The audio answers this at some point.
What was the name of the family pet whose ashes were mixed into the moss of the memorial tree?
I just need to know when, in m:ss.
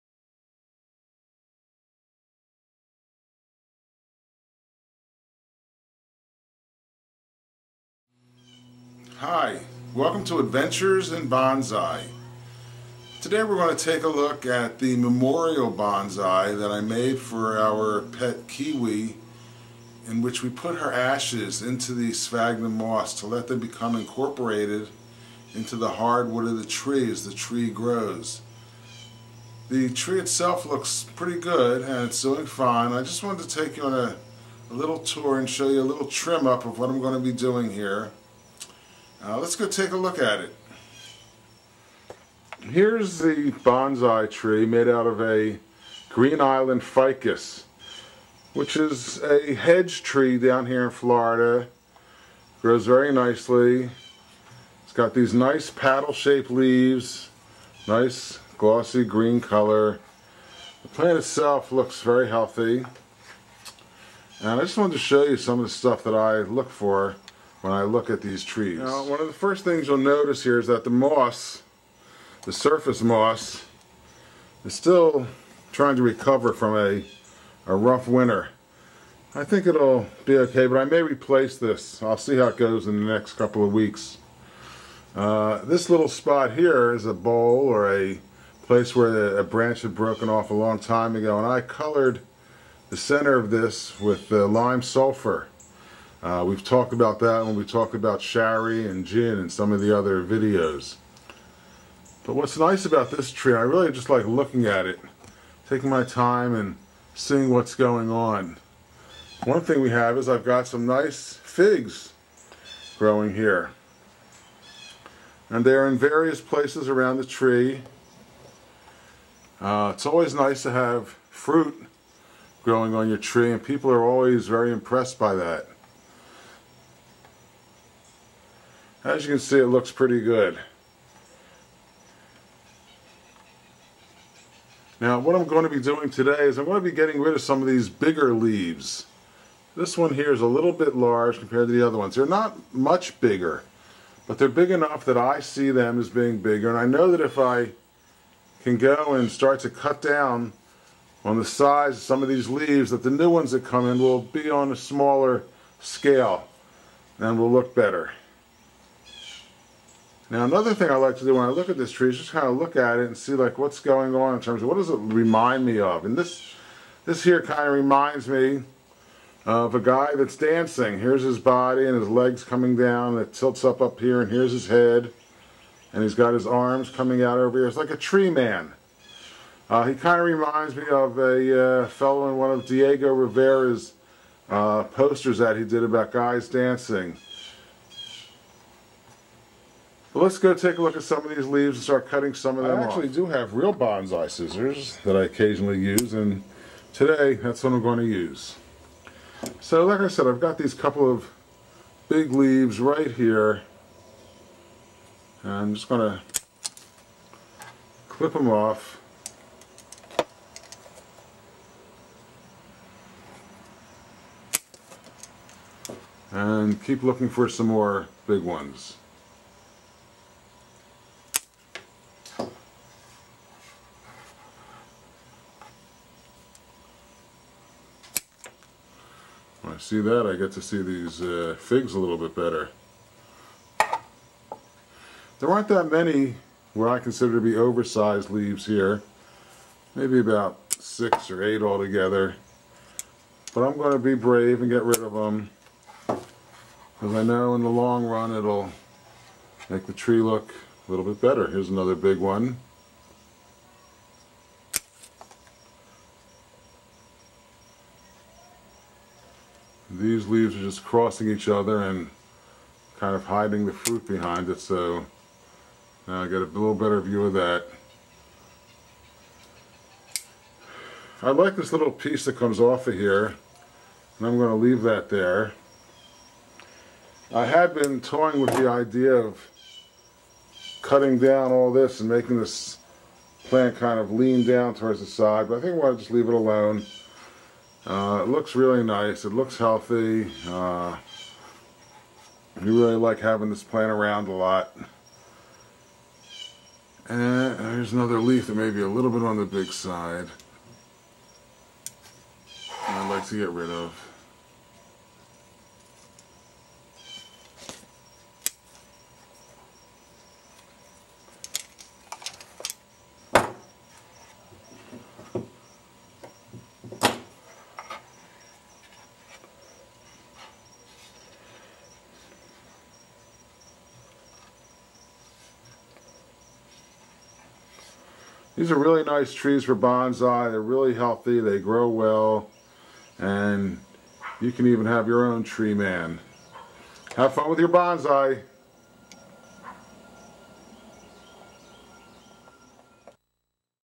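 0:18.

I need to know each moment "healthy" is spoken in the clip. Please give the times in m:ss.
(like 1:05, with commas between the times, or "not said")
1:02, 4:49, 5:30.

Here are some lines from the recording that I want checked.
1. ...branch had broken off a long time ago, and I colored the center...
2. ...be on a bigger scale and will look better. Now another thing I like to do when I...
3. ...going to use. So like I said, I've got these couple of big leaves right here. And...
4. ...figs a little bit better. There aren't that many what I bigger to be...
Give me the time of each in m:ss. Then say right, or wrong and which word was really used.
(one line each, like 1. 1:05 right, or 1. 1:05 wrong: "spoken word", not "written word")
1. 1:29 right
2. 2:34 wrong: "smaller", not "bigger"
3. 3:17 right
4. 3:51 wrong: "consider", not "bigger".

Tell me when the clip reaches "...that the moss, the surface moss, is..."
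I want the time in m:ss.
1:10.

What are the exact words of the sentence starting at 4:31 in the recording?
I like this little piece that comes off of here, and I'm going to leave that there.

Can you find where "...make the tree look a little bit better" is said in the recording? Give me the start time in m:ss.
4:09.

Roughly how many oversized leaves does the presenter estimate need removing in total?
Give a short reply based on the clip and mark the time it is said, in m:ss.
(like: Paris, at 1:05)
6 or 8, at 4:00.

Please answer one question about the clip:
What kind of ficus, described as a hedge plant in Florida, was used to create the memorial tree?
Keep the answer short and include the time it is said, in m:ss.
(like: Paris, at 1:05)
Green Island ficus, at 0:46.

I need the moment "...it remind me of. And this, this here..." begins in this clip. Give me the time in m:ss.
2:44.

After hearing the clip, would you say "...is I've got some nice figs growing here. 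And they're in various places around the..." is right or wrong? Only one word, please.
right.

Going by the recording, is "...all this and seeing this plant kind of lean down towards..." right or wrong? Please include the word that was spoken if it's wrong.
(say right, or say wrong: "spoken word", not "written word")
wrong: "making", not "seeing".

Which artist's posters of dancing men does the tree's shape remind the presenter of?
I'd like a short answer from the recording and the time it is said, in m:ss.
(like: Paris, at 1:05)
Diego Rivera, at 3:02.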